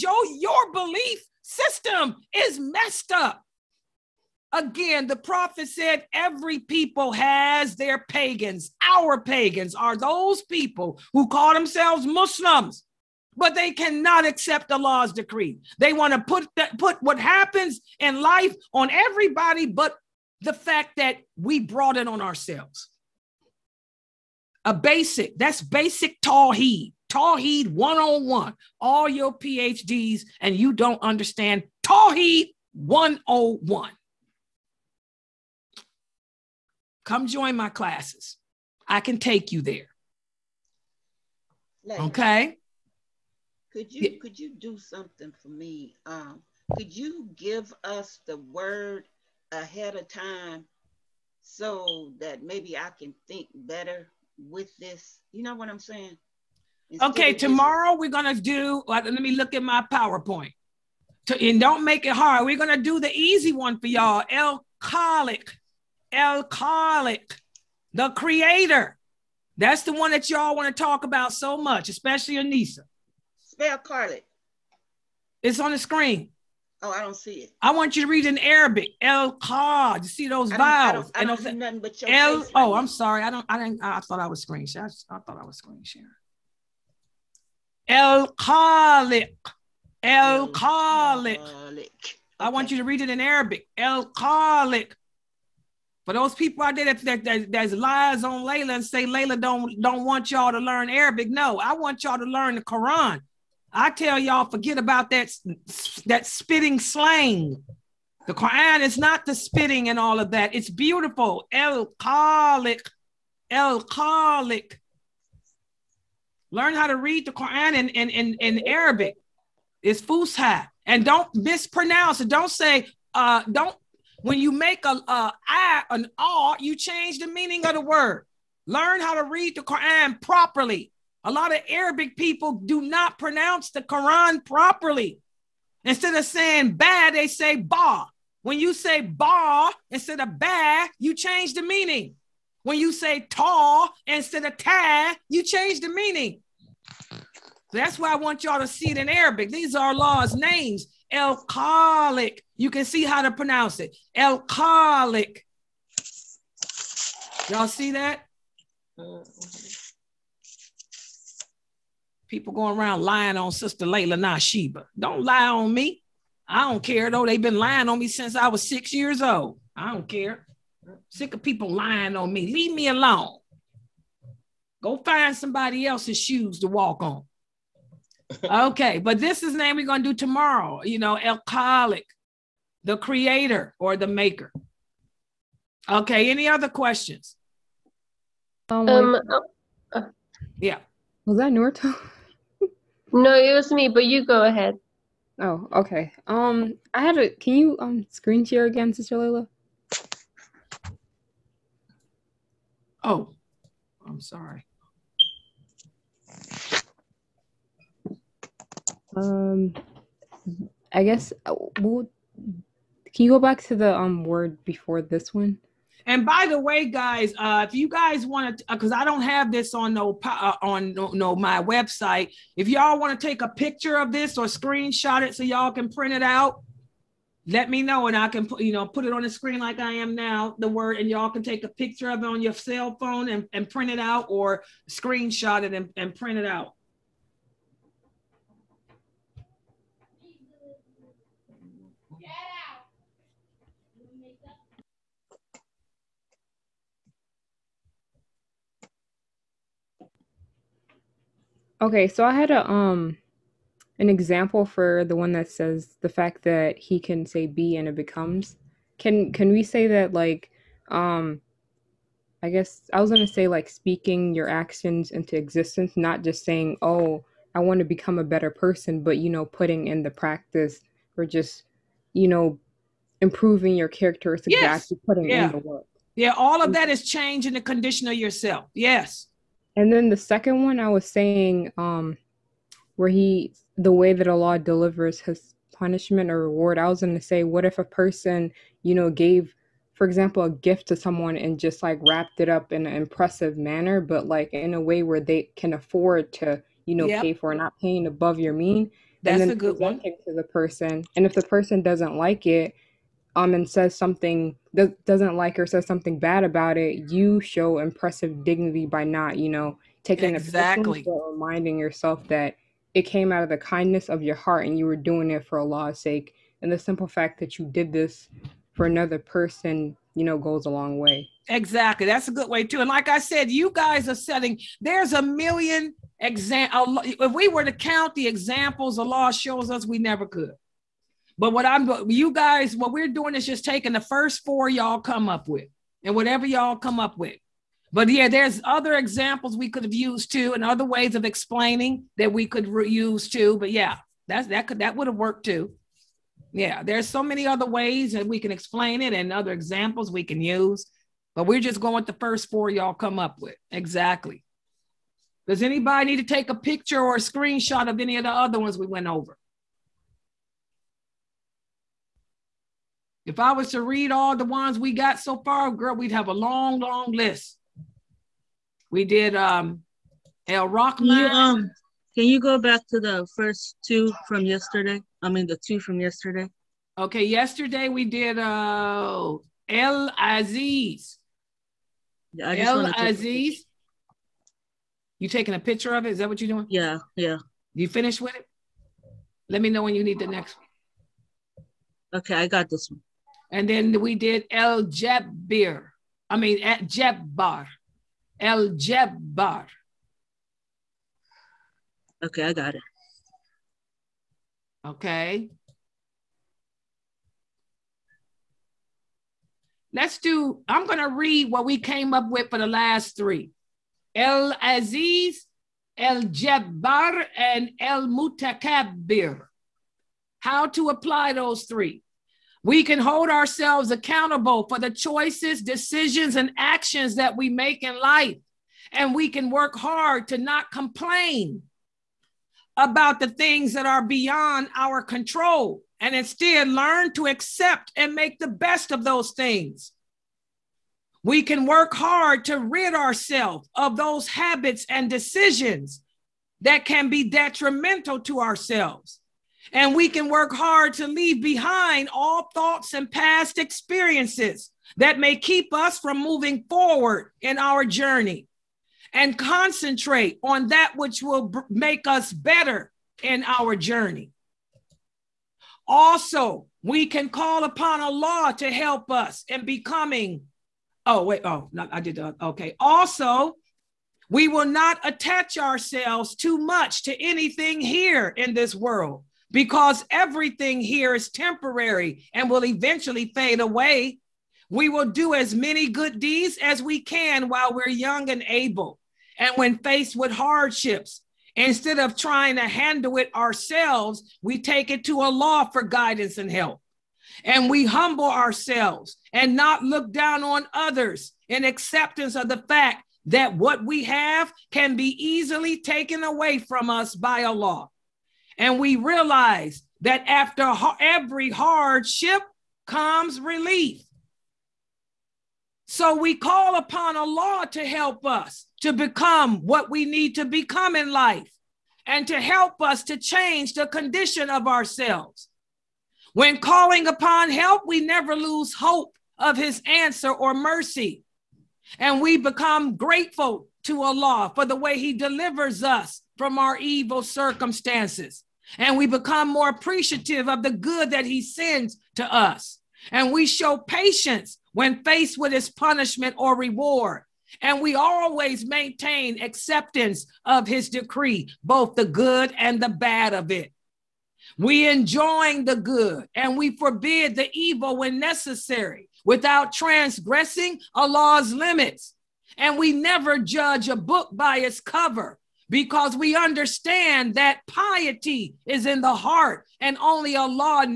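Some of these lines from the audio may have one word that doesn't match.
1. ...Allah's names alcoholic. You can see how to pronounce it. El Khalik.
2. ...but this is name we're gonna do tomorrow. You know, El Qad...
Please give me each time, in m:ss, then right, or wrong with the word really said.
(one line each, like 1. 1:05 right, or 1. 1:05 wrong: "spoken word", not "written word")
1. 2:29 right
2. 2:58 wrong: "Khalik", not "Qad".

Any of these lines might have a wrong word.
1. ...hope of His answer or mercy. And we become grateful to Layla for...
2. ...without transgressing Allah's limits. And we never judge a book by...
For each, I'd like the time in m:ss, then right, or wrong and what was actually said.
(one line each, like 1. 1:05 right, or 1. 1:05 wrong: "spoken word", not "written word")
1. 8:48 wrong: "Allah", not "Layla"
2. 9:19 right.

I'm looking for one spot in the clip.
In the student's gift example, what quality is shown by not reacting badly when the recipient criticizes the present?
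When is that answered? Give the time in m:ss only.
5:07.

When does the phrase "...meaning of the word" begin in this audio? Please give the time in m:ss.
2:07.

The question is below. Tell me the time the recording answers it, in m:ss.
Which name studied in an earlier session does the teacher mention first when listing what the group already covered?
6:10.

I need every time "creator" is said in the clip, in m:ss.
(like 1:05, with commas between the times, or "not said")
1:08, 3:02.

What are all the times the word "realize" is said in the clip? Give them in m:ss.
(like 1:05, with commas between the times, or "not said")
8:28.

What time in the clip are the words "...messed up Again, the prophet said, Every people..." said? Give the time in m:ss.
0:02.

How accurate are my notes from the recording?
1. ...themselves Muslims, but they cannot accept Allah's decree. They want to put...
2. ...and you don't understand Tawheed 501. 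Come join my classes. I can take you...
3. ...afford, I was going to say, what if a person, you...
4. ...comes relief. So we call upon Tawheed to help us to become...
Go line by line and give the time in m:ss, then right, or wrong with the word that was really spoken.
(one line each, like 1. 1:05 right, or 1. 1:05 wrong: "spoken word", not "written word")
1. 0:11 right
2. 0:30 wrong: "101", not "501"
3. 4:46 wrong: "reward", not "afford"
4. 8:32 wrong: "Allah", not "Tawheed".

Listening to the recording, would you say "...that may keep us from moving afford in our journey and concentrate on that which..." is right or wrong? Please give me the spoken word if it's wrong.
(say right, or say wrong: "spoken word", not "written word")
wrong: "forward", not "afford".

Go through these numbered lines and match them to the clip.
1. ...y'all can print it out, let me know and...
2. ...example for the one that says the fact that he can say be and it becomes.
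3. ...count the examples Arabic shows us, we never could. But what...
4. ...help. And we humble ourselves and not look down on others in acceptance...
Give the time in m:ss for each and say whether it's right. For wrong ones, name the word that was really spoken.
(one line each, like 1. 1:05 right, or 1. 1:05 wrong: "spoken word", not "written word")
1. 3:45 right
2. 4:14 right
3. 5:27 wrong: "Allah", not "Arabic"
4. 8:16 right.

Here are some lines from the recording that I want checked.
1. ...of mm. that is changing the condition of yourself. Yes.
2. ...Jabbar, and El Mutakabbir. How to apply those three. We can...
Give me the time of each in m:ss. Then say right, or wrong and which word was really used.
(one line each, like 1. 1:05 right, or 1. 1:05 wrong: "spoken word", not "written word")
1. 4:36 right
2. 6:56 right.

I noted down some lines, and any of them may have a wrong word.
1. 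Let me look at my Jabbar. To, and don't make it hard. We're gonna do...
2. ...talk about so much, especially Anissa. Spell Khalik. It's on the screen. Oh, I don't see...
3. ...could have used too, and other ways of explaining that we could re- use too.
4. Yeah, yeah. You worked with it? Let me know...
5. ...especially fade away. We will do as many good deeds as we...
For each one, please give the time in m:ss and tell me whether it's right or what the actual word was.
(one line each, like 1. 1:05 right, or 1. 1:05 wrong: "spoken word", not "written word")
1. 0:58 wrong: "PowerPoint", not "Jabbar"
2. 1:10 right
3. 5:39 right
4. 6:26 wrong: "finished", not "worked"
5. 8:02 wrong: "eventually", not "especially".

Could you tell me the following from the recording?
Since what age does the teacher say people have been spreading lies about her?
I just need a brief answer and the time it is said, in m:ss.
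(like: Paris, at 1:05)
6, at 2:48.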